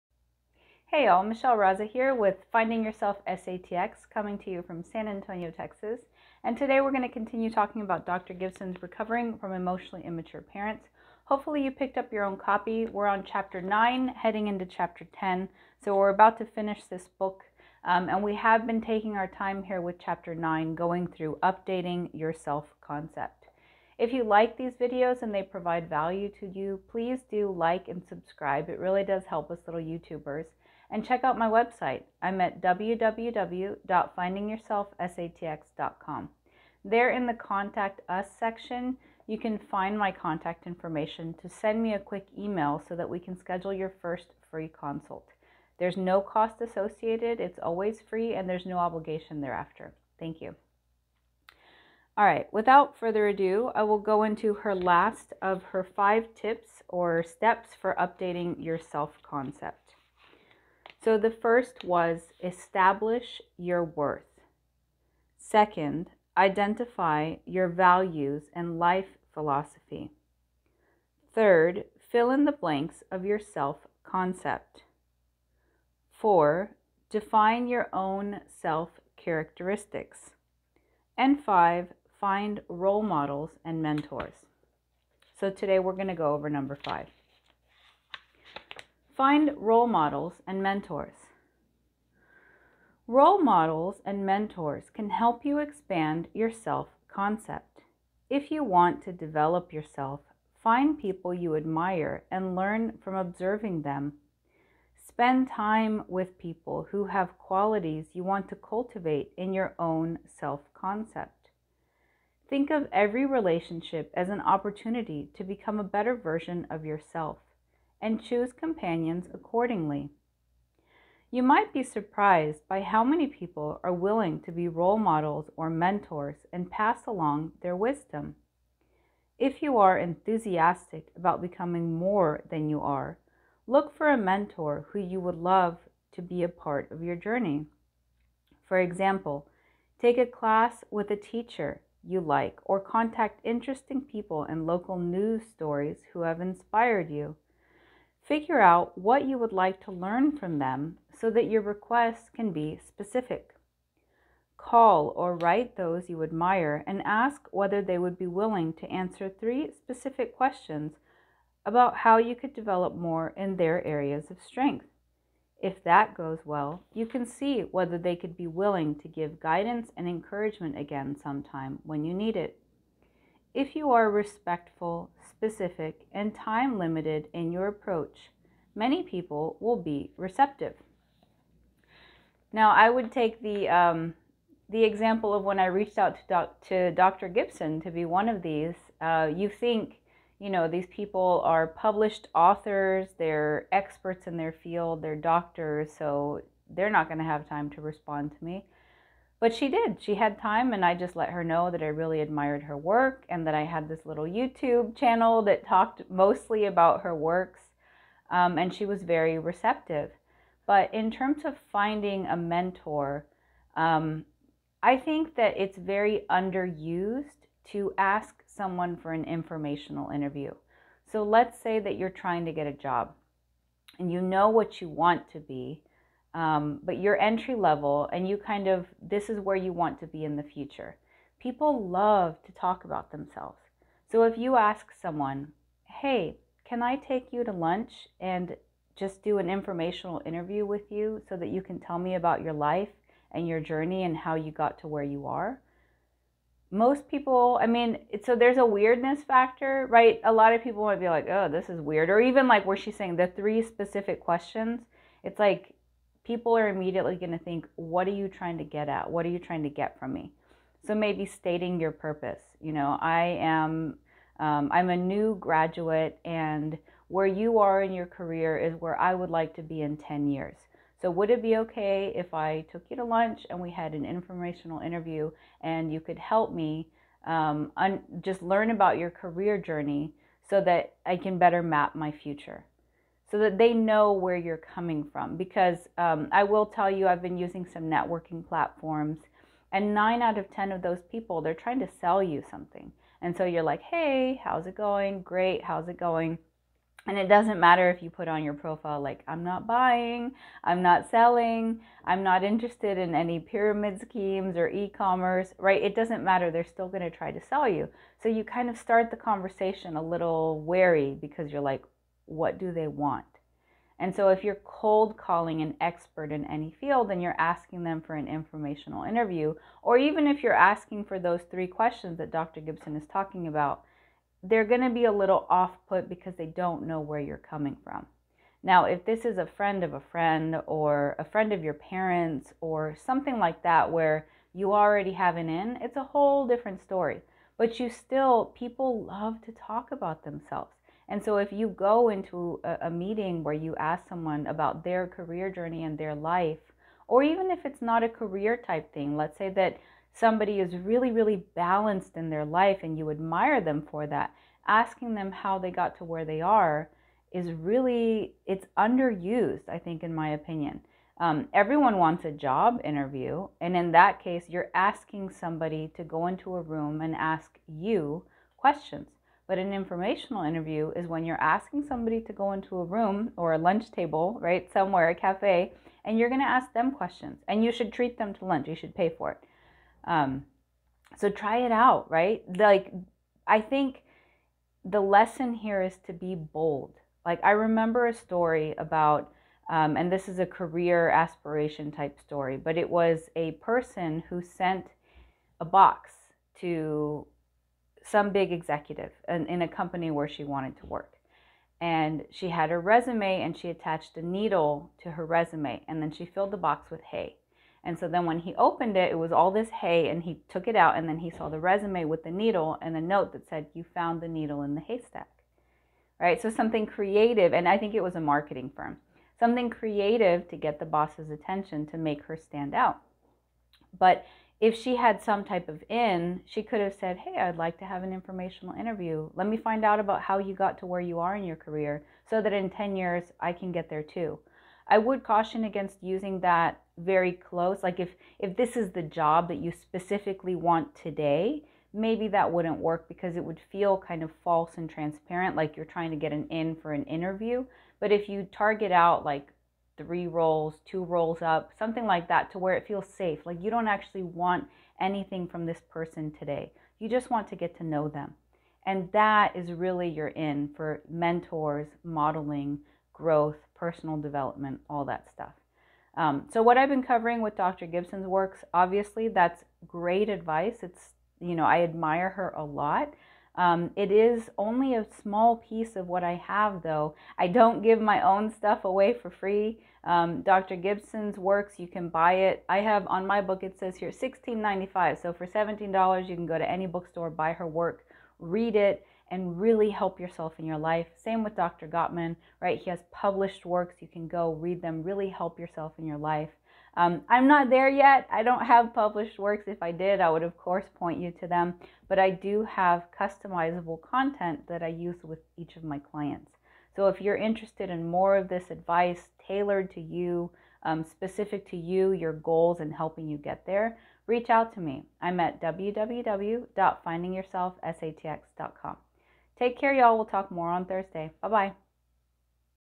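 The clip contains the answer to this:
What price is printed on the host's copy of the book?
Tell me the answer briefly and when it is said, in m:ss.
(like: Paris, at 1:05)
$16.95, at 8:04.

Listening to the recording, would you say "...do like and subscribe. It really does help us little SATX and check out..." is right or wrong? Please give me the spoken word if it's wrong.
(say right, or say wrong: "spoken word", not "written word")
wrong: "YouTubers", not "SATX".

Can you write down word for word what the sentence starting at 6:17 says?
And you should treat them to lunch, you should pay for it.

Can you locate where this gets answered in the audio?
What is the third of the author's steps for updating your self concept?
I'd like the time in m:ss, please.
1:12.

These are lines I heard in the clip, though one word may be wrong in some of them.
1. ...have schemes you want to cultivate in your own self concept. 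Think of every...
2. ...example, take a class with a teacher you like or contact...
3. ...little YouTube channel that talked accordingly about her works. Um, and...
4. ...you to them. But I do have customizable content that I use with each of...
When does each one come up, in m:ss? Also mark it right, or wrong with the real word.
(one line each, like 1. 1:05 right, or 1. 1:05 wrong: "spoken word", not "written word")
1. 1:47 wrong: "qualities", not "schemes"
2. 2:18 right
3. 3:24 wrong: "mostly", not "accordingly"
4. 8:21 right.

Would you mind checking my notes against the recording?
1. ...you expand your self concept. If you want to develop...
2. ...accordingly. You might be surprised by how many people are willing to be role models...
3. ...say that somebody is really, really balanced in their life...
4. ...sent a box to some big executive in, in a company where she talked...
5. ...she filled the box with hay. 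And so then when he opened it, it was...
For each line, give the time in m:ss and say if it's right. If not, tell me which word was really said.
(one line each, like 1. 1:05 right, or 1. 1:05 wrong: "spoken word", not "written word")
1. 1:35 right
2. 1:59 right
3. 5:49 right
4. 6:34 wrong: "wanted", not "talked"
5. 6:46 right.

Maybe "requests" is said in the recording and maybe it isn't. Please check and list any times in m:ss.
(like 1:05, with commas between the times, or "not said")
2:31.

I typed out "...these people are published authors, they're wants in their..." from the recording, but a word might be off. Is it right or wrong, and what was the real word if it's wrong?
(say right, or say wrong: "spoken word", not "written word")
wrong: "experts", not "wants".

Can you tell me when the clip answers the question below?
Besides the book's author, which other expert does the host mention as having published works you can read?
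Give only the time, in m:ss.
8:11.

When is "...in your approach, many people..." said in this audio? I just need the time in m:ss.
2:57.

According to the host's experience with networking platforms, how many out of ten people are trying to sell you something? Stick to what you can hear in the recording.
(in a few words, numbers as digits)
9.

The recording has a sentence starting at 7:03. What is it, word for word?
But if she had some type of in, she could have said, Hey, I'd like to have an informational interview.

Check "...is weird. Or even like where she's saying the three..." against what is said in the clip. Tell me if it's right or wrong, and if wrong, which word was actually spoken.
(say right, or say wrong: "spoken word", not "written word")
right.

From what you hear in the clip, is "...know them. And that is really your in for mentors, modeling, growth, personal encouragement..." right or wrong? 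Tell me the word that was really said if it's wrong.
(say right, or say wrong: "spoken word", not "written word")
wrong: "development", not "encouragement".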